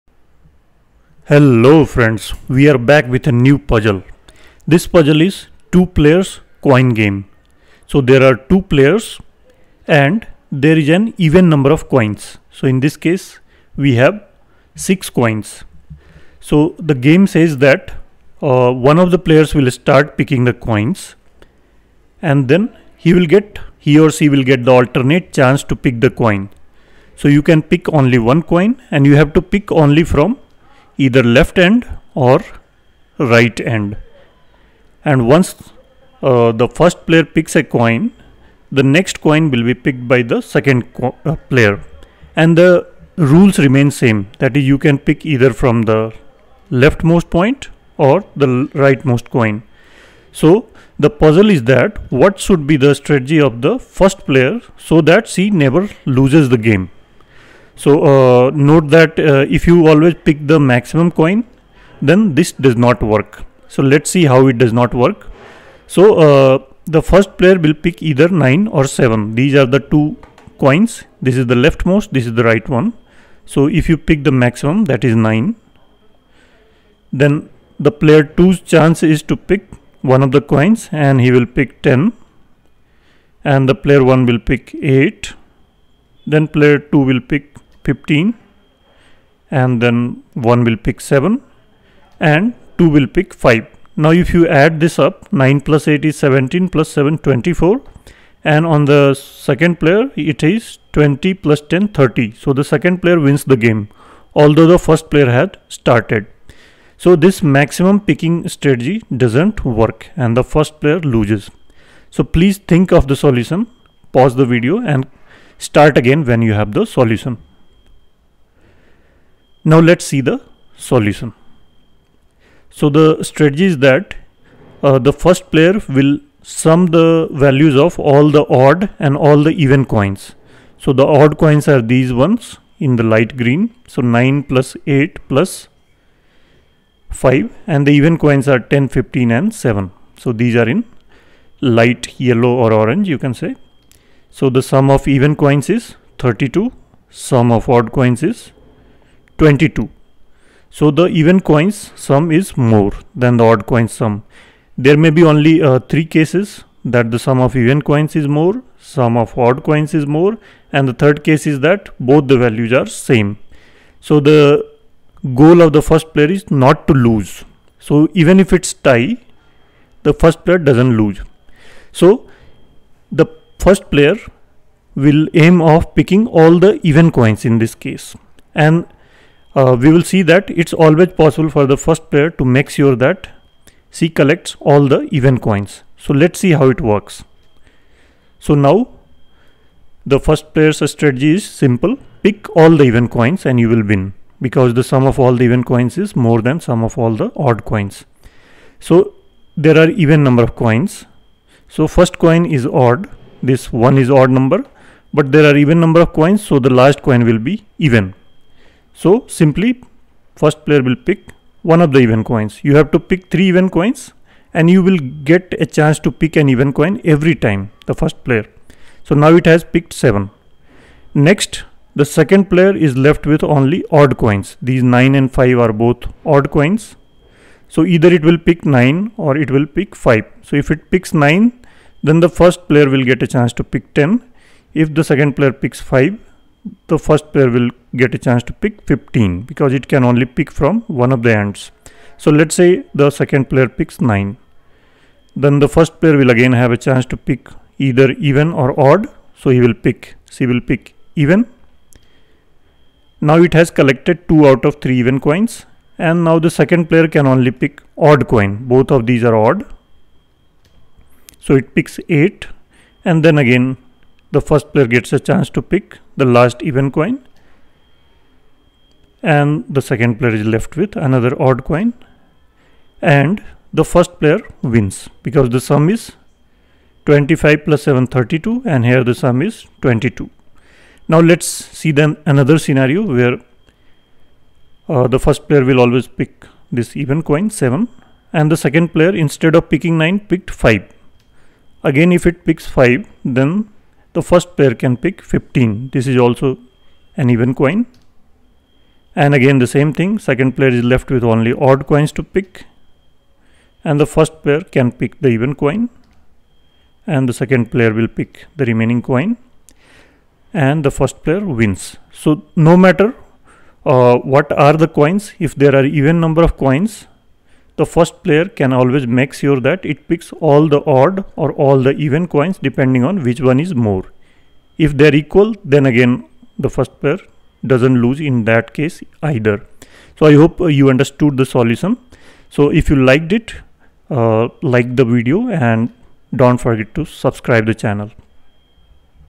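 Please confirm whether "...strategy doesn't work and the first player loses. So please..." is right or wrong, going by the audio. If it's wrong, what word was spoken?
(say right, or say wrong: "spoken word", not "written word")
right.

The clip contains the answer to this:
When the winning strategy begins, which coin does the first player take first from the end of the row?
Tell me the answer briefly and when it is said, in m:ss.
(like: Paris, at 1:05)
7, at 3:39.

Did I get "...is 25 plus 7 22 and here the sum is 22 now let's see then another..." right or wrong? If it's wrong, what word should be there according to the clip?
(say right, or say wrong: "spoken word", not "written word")
wrong: "32", not "22".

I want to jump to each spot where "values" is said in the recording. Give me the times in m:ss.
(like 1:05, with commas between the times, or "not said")
2:07, 2:42.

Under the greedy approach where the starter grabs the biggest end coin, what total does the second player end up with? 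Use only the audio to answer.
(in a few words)
30.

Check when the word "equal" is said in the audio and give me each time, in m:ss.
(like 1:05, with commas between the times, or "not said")
5:25.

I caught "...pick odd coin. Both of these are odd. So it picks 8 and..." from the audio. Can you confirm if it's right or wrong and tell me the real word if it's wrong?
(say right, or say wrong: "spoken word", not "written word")
right.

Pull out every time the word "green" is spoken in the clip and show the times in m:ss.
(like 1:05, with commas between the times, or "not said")
2:13.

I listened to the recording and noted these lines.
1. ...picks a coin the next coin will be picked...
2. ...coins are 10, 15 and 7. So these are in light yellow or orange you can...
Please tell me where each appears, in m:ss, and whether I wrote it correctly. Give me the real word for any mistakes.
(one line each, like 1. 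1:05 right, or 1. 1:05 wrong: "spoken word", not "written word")
1. 0:37 right
2. 2:18 right.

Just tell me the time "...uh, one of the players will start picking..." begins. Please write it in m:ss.
0:18.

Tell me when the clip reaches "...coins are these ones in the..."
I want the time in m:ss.
2:11.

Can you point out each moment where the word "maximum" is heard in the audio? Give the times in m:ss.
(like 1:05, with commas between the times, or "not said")
1:00, 1:14, 1:47.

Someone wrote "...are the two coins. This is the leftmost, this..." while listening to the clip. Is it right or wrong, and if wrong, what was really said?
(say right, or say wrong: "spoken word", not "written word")
right.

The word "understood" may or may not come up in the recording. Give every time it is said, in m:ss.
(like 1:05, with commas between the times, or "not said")
5:30.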